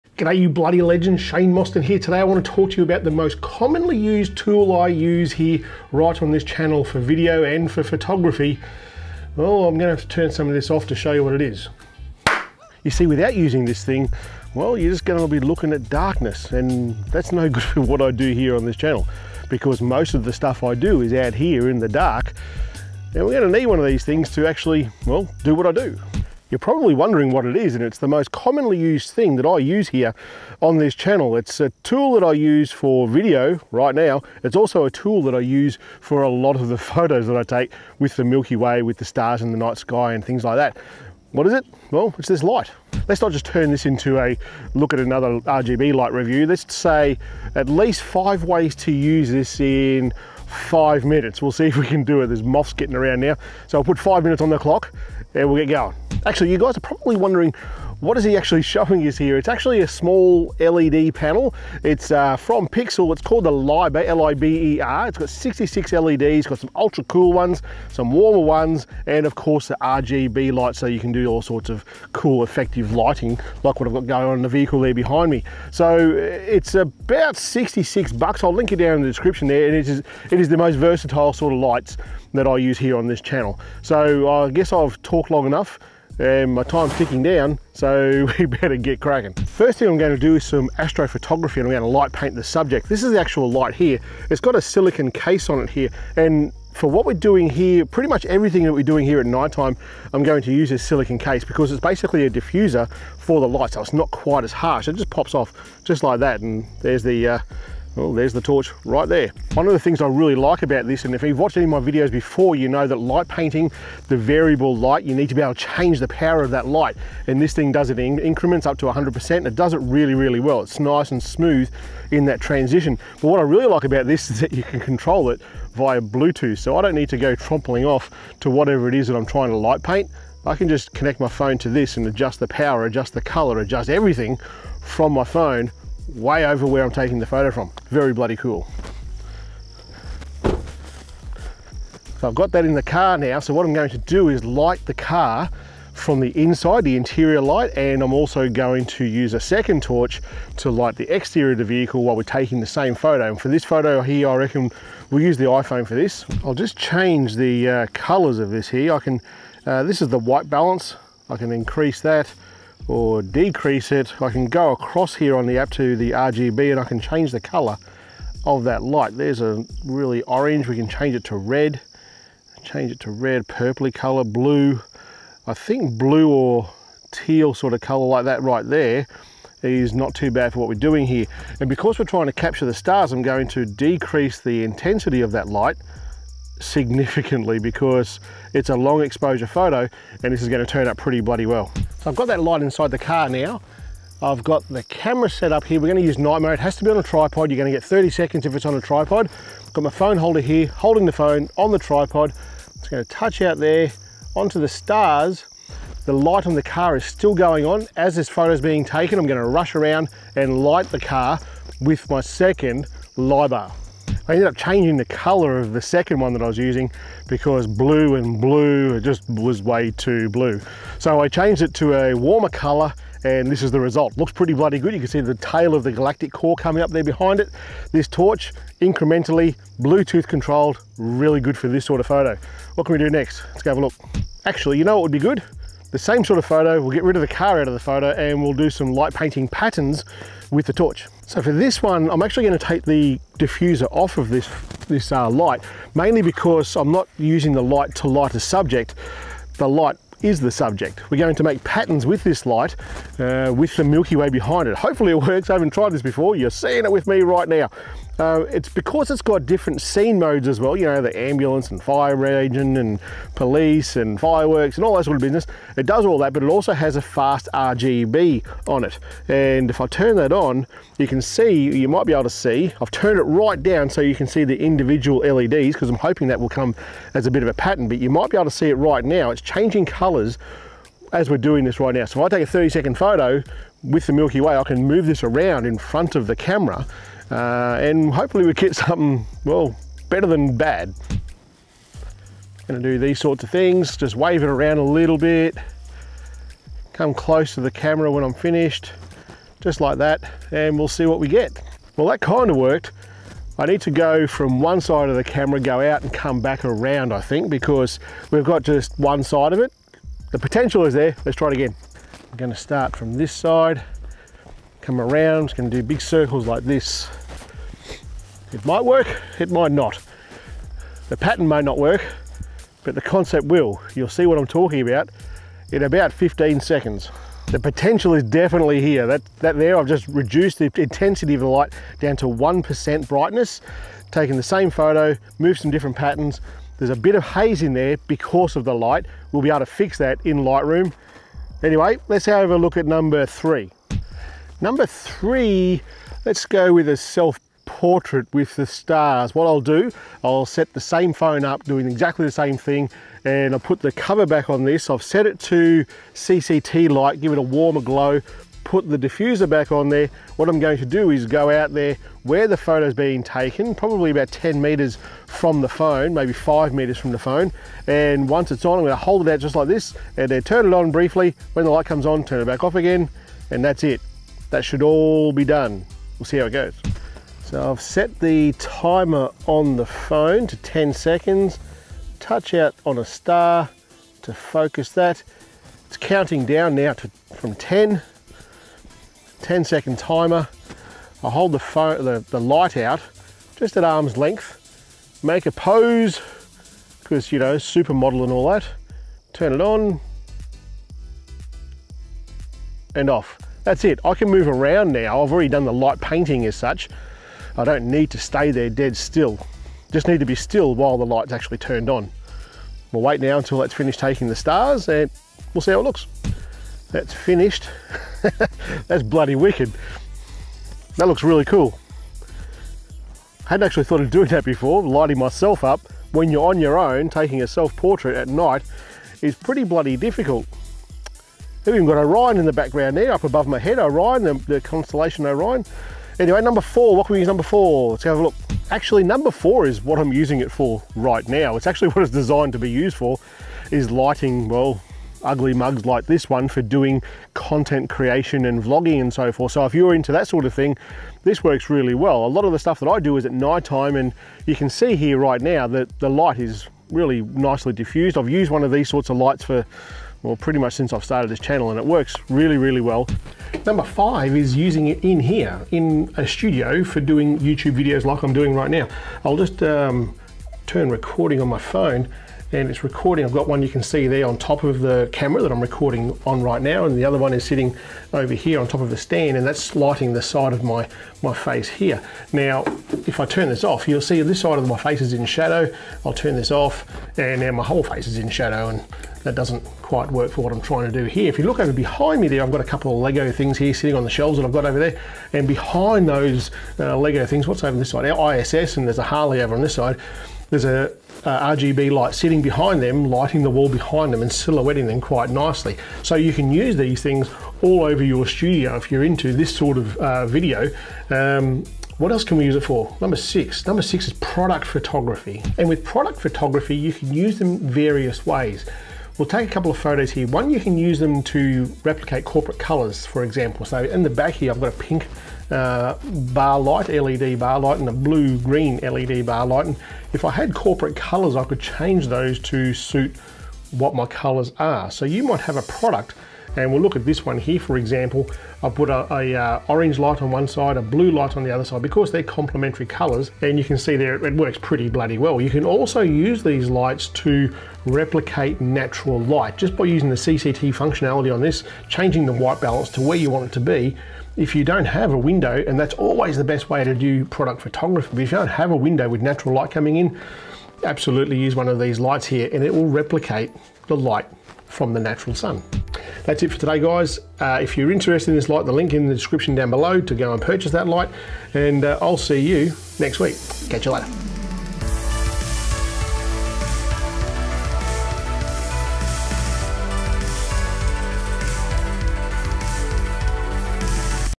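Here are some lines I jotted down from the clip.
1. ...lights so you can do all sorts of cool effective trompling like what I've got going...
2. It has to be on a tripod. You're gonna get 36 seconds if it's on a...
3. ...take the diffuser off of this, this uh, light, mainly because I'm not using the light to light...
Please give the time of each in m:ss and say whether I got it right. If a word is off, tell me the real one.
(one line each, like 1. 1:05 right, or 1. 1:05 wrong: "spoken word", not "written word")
1. 1:10 wrong: "lighting", not "trompling"
2. 3:16 wrong: "30", not "36"
3. 4:02 right.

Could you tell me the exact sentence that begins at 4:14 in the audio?
Hopefully it works, I haven't tried this before.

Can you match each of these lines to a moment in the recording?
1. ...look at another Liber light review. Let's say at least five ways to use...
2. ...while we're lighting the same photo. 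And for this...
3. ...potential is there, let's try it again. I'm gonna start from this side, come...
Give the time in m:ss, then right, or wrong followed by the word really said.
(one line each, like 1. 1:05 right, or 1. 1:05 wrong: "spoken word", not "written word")
1. 0:44 wrong: "RGB", not "Liber"
2. 2:32 wrong: "taking", not "lighting"
3. 5:10 right.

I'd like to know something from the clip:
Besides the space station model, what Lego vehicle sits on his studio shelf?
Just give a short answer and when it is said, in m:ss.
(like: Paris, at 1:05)
A Harley, at 8:18.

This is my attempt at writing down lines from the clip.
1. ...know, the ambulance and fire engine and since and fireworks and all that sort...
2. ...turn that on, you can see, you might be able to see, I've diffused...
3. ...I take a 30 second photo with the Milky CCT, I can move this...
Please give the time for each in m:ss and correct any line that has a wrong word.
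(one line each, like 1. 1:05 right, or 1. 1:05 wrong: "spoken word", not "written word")
1. 4:20 wrong: "police", not "since"
2. 4:29 wrong: "turned", not "diffused"
3. 4:42 wrong: "Way", not "CCT".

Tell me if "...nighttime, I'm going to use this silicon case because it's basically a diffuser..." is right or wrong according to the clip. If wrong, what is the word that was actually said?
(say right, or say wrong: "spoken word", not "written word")
right.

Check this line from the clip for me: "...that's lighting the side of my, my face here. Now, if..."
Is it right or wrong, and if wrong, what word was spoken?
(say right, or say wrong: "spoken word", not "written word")
right.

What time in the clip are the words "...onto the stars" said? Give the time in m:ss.
3:24.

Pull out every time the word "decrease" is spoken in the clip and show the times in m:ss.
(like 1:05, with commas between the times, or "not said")
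2:43, 3:03.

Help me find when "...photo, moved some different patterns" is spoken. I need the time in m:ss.
5:34.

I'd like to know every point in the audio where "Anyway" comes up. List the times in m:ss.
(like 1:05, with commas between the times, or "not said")
5:41, 7:16.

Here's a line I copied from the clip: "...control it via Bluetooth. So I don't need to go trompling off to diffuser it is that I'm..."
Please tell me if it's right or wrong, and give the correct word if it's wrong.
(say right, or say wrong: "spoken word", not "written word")
wrong: "whatever", not "diffuser".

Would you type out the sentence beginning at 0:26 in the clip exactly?
You're probably wondering what it is, and it's the most commonly used thing that I use here on this channel.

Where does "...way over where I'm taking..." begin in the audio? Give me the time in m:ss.
2:16.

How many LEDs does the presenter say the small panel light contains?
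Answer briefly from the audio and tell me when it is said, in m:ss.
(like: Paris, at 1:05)
66, at 1:05.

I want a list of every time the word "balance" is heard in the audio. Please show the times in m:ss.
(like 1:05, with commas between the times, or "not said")
2:40, 9:12.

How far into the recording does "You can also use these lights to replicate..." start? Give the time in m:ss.
9:05.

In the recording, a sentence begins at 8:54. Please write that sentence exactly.
So you might have a product and we'll look at this one here, for example.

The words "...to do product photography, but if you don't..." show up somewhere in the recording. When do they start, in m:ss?
9:16.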